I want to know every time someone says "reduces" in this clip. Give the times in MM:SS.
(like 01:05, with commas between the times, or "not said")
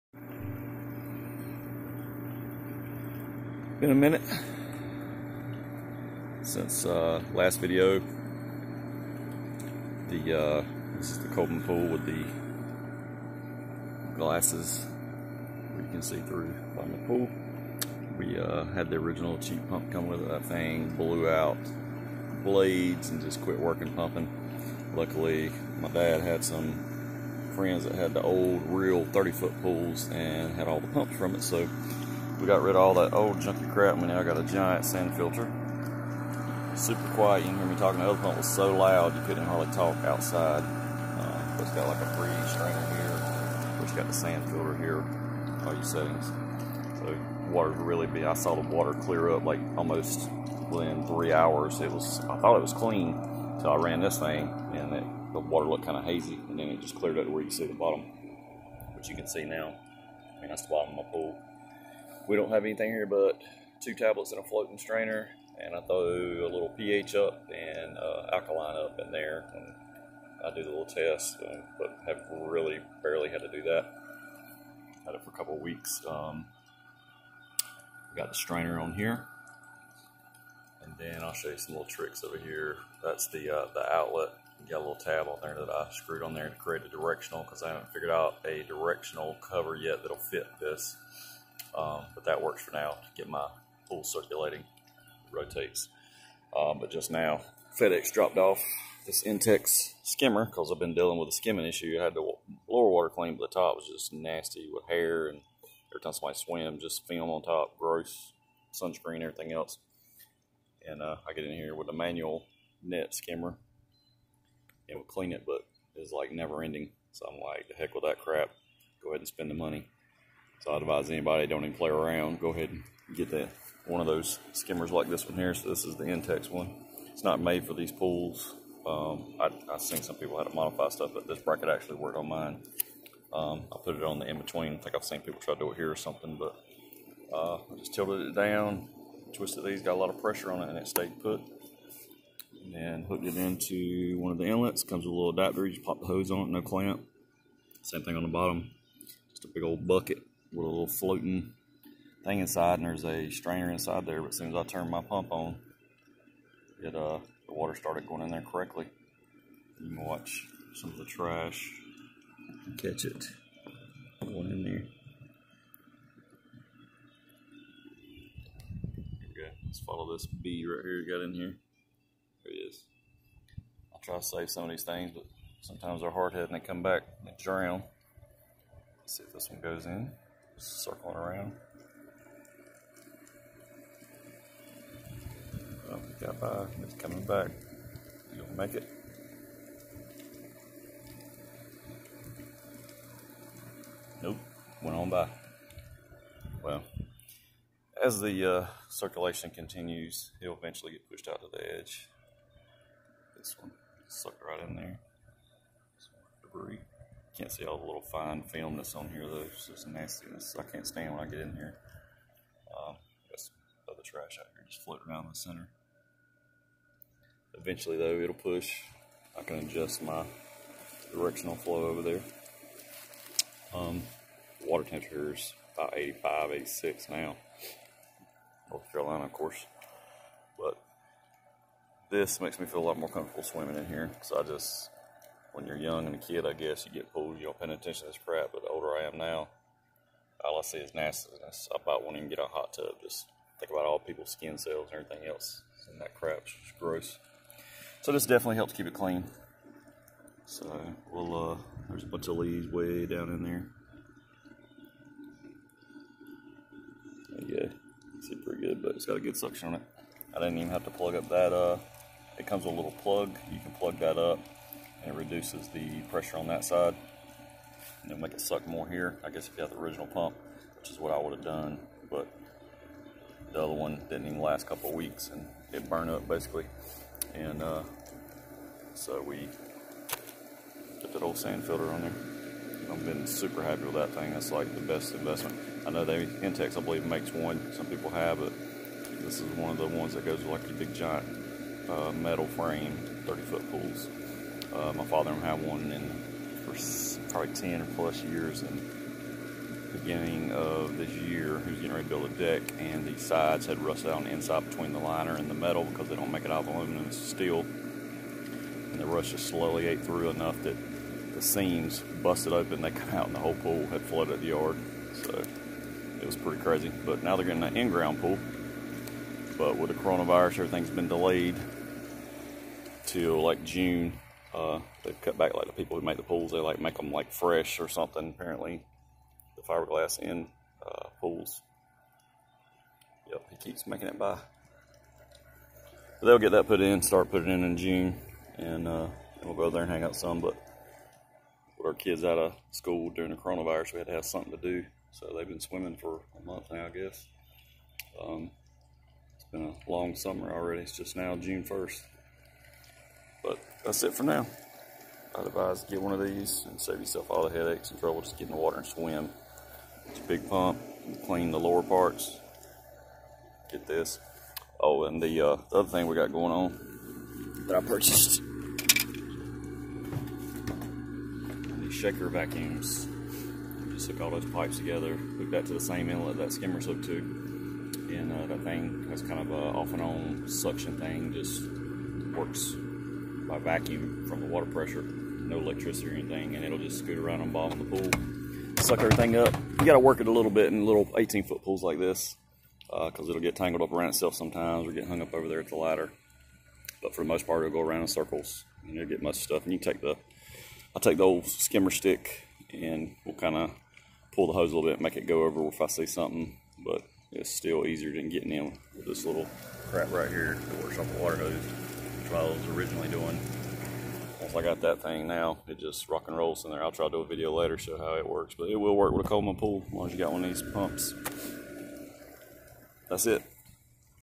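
04:25.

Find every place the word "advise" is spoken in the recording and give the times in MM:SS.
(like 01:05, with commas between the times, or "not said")
02:00, 05:55.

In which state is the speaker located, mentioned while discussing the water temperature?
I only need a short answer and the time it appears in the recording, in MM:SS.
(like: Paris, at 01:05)
North Carolina, at 03:48.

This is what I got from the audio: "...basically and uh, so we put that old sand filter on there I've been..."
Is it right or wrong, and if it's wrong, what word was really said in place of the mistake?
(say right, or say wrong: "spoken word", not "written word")
right.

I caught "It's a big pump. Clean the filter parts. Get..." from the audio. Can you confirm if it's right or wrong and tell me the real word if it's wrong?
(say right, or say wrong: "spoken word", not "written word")
wrong: "lower", not "filter".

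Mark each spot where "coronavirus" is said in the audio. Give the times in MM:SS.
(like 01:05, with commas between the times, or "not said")
05:20, 05:43.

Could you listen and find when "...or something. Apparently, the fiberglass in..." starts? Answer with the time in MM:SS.
05:27.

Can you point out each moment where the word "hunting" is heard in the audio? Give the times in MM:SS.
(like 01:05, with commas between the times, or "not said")
not said.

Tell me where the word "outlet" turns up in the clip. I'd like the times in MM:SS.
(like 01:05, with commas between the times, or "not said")
01:23.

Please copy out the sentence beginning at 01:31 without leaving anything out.
Um, but that works for now to get my pool circulating, rotates.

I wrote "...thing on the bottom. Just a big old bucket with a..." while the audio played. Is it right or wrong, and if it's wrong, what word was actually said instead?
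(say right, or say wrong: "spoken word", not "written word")
right.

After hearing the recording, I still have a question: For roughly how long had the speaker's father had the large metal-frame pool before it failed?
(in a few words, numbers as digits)
10 plus years.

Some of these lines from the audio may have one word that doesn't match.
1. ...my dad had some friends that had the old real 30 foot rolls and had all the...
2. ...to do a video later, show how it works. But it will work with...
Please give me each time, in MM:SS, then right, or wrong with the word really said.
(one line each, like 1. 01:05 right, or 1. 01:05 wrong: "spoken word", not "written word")
1. 00:25 wrong: "pools", not "rolls"
2. 06:57 right.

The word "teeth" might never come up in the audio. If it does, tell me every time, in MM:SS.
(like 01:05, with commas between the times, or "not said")
not said.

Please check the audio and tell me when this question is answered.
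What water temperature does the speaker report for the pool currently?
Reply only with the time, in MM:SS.
03:45.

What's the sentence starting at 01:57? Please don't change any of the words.
So I'm like, the heck with that crap.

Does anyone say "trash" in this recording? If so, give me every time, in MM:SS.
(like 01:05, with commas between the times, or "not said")
02:41, 03:34.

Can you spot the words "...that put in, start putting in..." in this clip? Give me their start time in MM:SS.
05:36.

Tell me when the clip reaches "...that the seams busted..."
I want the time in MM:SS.
05:10.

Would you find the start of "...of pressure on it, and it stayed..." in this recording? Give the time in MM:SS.
02:20.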